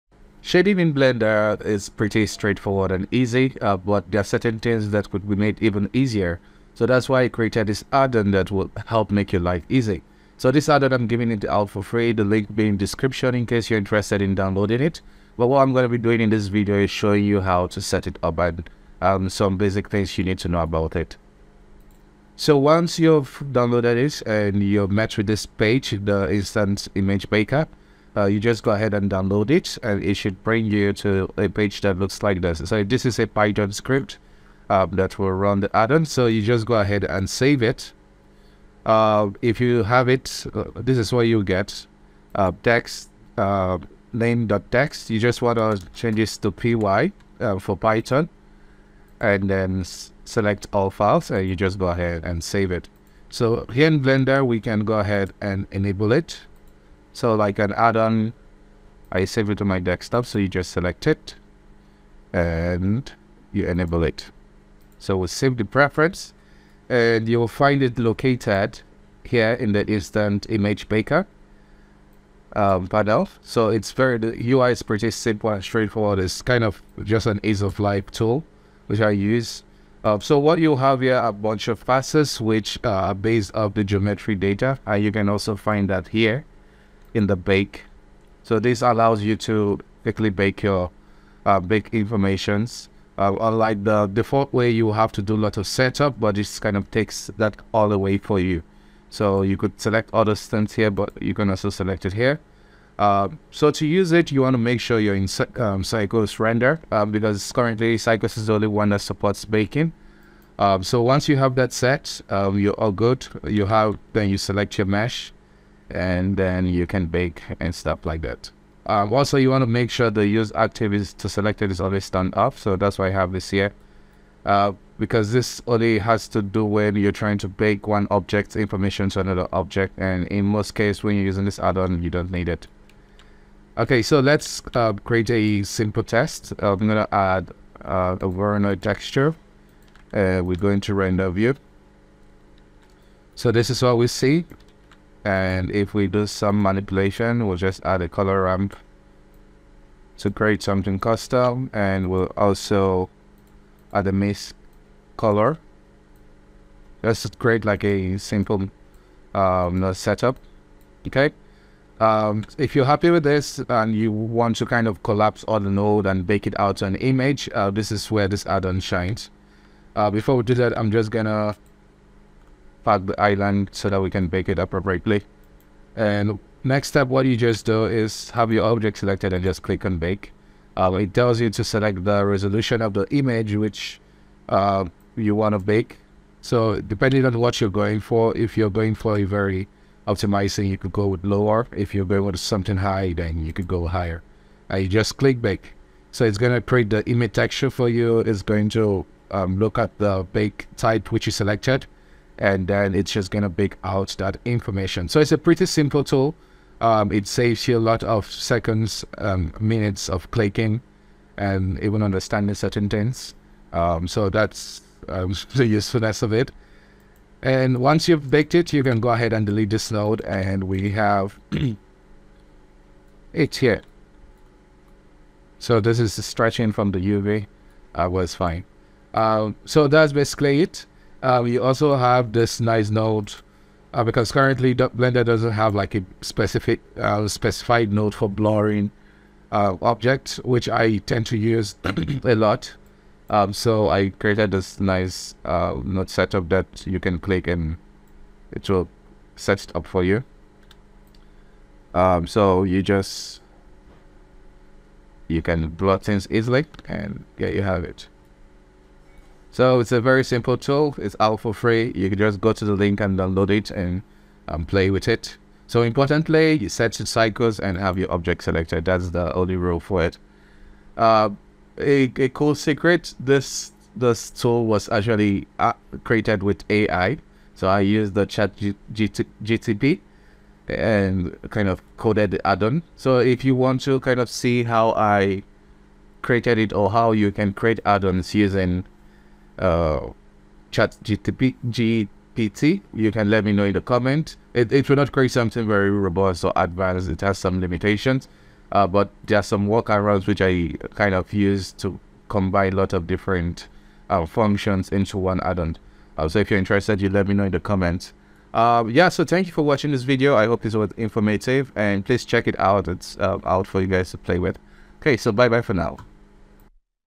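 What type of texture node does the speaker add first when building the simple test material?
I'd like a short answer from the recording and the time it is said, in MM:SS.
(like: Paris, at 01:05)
Voronoi texture, at 02:18.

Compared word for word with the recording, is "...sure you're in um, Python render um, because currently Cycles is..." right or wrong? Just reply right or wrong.
wrong.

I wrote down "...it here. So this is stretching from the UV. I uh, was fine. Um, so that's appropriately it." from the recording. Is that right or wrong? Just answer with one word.
wrong.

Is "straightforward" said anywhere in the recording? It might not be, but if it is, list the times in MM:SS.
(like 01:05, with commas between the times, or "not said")
00:02, 01:15.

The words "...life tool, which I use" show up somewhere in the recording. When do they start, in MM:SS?
01:17.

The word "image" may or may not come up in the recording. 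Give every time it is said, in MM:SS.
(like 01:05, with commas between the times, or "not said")
00:26, 01:10, 02:46, 03:03, 03:17.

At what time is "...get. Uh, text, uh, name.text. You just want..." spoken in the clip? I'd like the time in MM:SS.
00:41.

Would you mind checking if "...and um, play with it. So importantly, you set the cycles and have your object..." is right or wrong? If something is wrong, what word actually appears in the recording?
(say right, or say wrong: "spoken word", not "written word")
right.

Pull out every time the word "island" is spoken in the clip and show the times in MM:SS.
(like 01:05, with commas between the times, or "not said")
02:53.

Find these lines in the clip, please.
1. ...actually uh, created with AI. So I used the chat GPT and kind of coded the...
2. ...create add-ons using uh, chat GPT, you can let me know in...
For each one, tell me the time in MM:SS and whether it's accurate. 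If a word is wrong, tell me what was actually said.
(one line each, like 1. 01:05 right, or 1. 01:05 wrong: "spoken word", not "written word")
1. 04:34 right
2. 04:47 right.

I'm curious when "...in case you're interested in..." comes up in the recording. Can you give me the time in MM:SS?
00:13.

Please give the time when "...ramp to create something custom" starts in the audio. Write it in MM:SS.
02:28.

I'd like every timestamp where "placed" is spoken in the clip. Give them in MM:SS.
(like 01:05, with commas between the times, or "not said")
not said.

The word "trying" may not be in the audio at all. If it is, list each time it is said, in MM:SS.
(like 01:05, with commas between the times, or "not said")
02:07.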